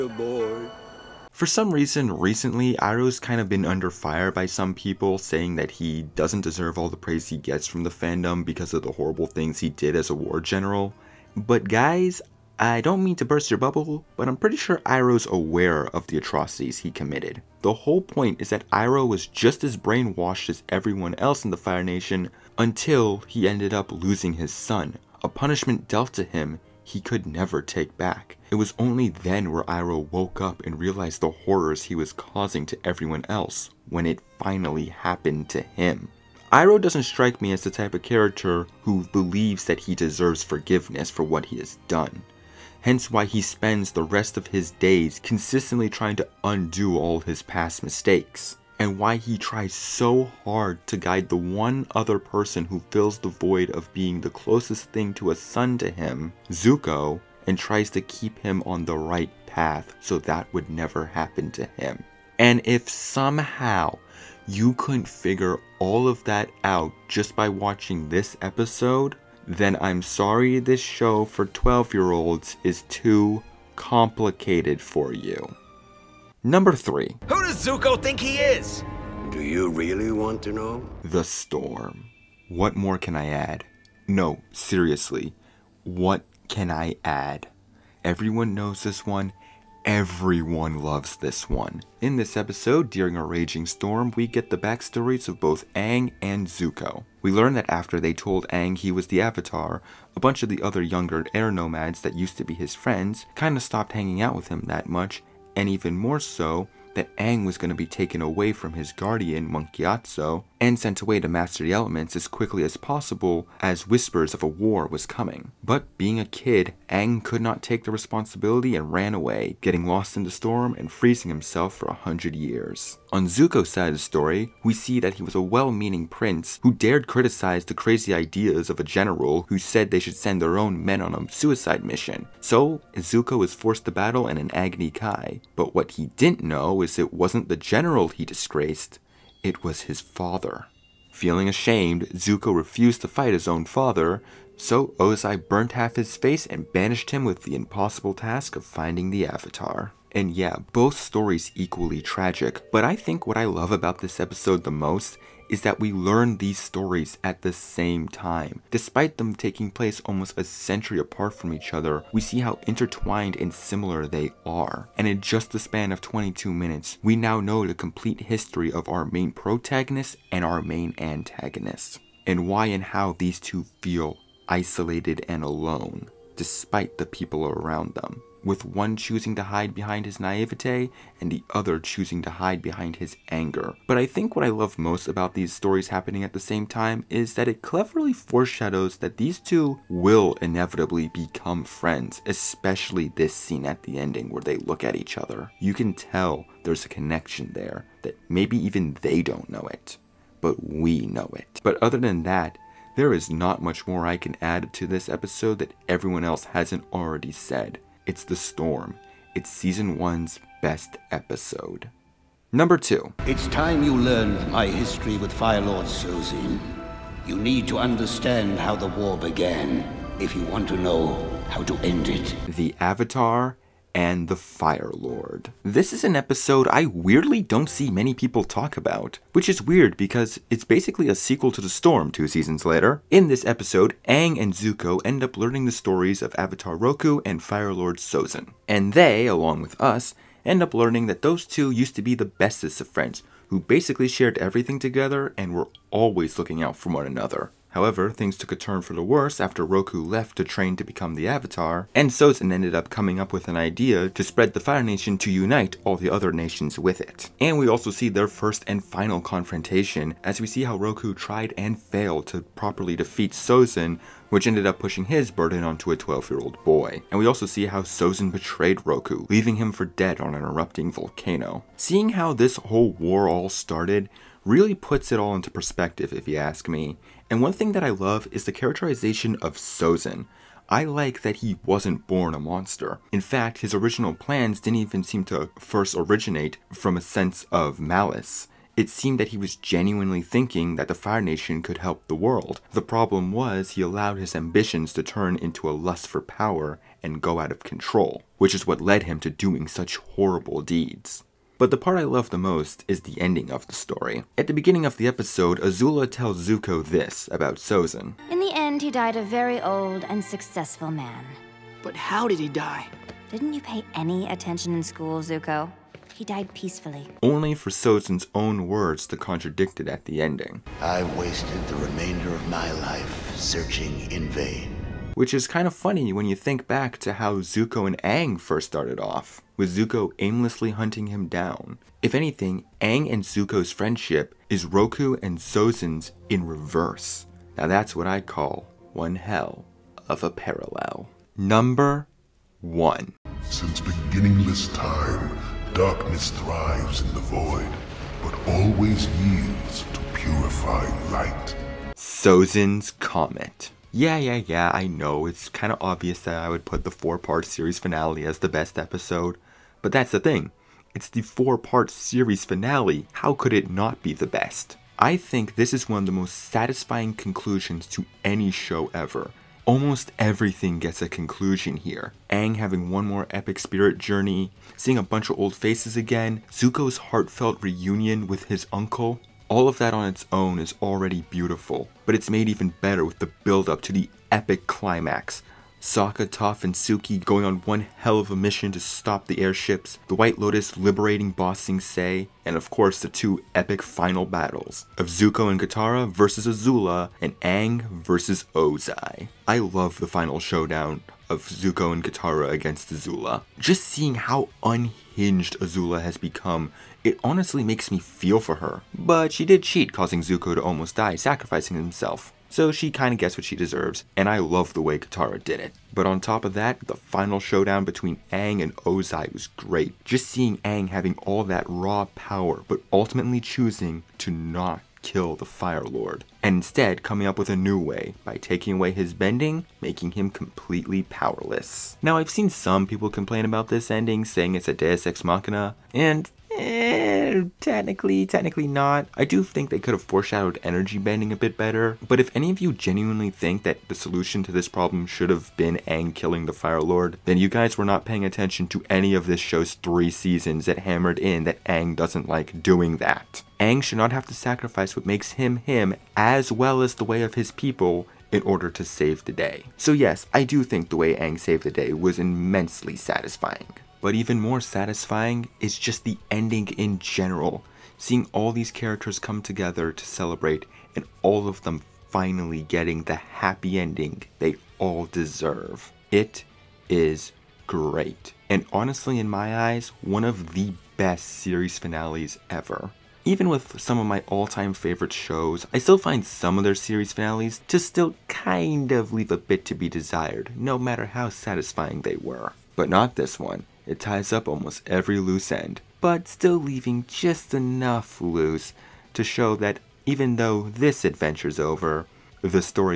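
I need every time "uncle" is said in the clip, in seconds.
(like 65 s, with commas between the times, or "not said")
378 s.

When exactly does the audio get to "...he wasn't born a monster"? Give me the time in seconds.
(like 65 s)
281 s.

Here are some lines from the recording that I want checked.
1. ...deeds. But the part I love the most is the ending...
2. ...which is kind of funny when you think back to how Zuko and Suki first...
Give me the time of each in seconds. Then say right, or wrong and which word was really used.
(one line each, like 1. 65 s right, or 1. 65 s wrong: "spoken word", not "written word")
1. 300 s right
2. 325 s wrong: "Aang", not "Suki".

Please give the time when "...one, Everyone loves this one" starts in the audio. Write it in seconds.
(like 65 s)
89 s.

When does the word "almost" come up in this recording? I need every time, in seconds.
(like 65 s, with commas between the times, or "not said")
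160 s, 369 s, 410 s, 494 s.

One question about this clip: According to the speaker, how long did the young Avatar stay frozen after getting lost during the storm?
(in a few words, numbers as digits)
a hundred years.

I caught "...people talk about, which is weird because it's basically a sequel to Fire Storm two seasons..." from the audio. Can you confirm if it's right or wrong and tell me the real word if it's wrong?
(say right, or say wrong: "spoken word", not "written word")
wrong: "The", not "Fire".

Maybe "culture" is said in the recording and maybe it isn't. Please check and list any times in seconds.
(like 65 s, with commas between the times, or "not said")
not said.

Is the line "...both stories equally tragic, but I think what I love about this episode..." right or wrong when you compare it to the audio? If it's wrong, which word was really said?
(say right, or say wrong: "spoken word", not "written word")
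right.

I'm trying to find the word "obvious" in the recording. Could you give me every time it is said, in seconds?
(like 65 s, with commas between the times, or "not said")
355 s.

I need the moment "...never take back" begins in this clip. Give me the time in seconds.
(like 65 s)
27 s.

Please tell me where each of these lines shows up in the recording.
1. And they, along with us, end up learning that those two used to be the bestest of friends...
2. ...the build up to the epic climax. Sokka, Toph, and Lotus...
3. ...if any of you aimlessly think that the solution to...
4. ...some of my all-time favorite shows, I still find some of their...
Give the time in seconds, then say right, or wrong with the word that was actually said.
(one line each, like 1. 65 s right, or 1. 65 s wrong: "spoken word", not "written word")
1. 238 s right
2. 383 s wrong: "Suki", not "Lotus"
3. 442 s wrong: "genuinely", not "aimlessly"
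4. 483 s right.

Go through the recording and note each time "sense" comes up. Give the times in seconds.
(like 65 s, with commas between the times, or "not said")
287 s.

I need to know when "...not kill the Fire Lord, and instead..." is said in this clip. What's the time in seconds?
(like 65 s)
424 s.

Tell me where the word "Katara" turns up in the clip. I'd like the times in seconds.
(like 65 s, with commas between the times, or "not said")
395 s, 402 s, 414 s.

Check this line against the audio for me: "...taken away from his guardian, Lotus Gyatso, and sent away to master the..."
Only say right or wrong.
wrong.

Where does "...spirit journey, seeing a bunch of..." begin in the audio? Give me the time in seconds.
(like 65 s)
373 s.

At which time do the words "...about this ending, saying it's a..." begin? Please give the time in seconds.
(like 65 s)
433 s.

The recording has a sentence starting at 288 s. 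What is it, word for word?
It seemed that he was genuinely thinking that the Fire Nation could help the world.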